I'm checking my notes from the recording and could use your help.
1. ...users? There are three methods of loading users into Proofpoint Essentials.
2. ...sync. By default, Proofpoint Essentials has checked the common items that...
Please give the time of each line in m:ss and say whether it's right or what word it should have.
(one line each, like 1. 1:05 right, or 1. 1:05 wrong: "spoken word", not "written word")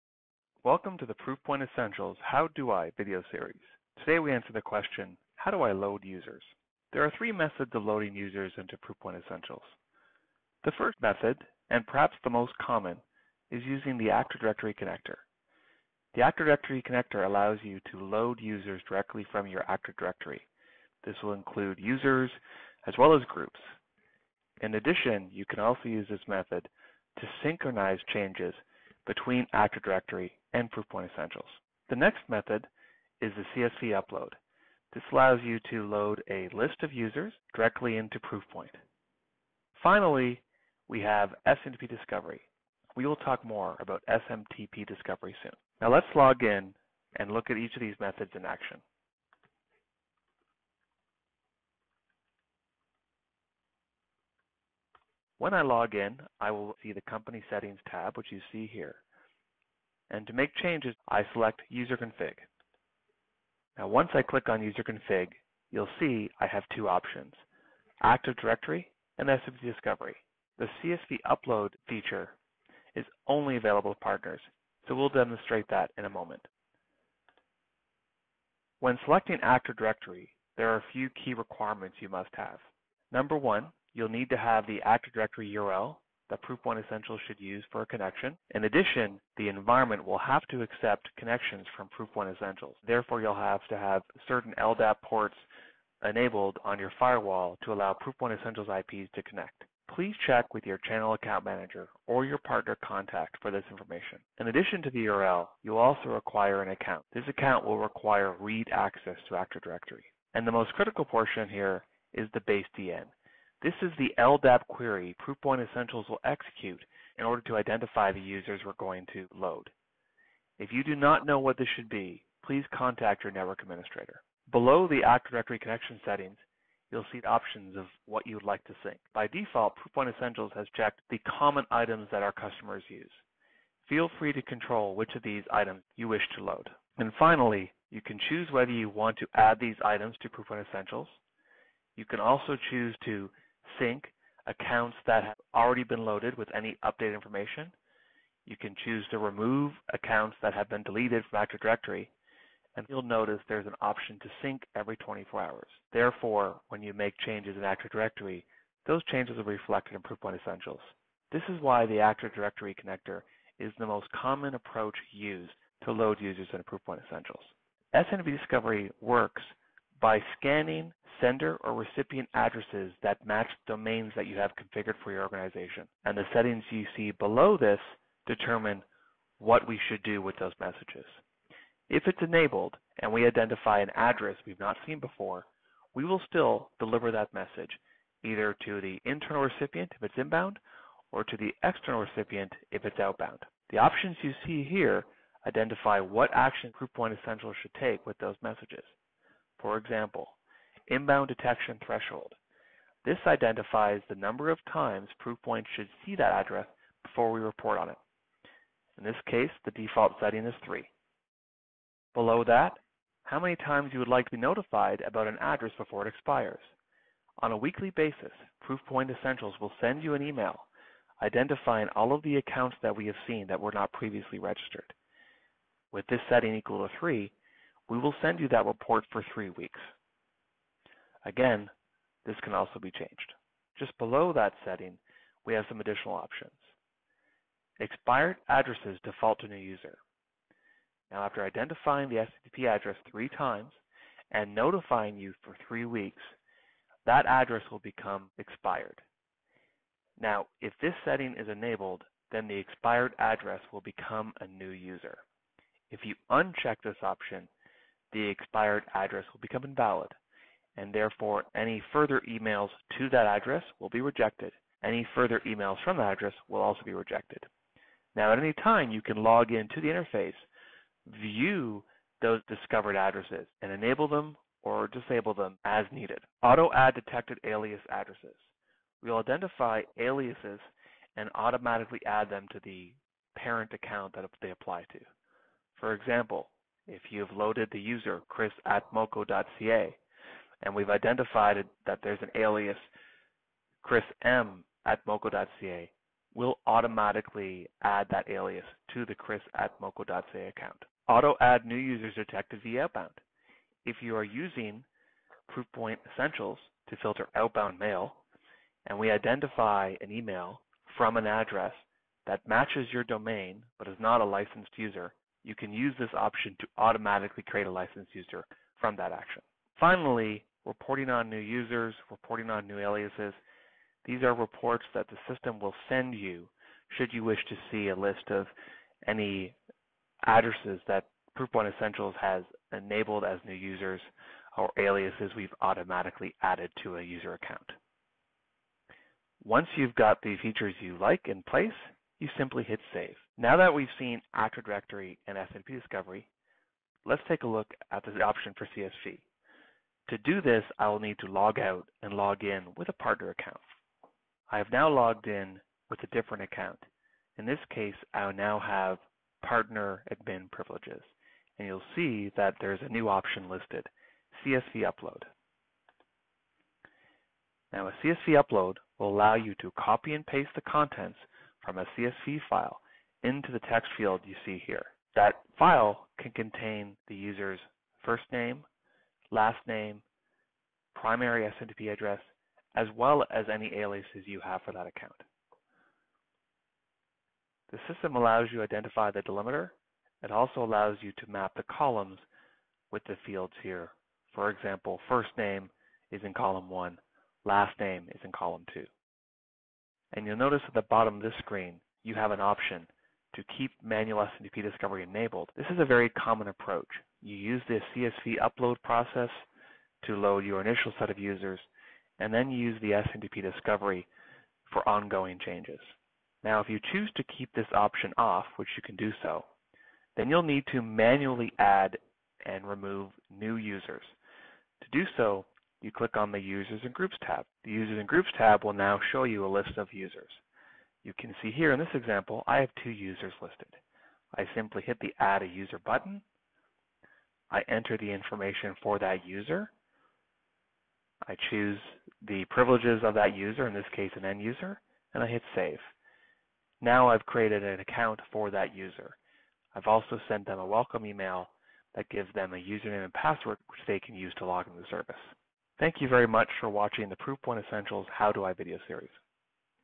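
1. 0:06 right
2. 2:08 right.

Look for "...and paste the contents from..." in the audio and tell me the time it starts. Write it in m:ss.
6:10.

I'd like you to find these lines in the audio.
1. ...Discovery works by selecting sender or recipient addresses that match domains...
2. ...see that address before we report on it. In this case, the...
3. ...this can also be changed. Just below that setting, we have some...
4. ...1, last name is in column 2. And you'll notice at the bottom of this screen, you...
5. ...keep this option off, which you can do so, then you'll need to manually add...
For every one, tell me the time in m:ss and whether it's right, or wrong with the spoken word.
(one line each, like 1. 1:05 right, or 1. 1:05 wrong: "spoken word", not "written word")
1. 2:48 wrong: "scanning", not "selecting"
2. 3:26 right
3. 3:52 right
4. 6:36 right
5. 6:57 right.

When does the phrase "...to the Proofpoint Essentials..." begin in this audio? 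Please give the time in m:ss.
0:00.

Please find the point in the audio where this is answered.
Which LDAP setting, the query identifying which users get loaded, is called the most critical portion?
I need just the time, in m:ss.
1:52.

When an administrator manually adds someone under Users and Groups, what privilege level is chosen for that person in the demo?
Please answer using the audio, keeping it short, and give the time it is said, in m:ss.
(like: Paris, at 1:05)
end user, at 7:24.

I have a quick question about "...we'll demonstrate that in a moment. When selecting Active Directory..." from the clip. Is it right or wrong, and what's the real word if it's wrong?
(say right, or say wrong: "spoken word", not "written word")
right.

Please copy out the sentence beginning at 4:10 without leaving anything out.
Now, if this setting is enabled, then the expired address will become a new user.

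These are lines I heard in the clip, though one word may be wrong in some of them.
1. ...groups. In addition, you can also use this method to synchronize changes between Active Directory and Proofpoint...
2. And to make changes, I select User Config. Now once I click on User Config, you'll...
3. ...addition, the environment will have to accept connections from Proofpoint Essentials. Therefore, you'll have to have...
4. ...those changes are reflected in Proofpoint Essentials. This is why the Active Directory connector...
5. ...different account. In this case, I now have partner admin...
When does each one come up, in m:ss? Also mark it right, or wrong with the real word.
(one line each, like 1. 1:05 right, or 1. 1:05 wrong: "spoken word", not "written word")
1. 0:23 right
2. 1:00 right
3. 1:28 right
4. 2:38 right
5. 5:56 right.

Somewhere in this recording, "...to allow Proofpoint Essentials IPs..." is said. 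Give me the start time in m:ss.
1:37.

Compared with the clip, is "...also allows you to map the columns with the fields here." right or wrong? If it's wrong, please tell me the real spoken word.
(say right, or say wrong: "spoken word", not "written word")
right.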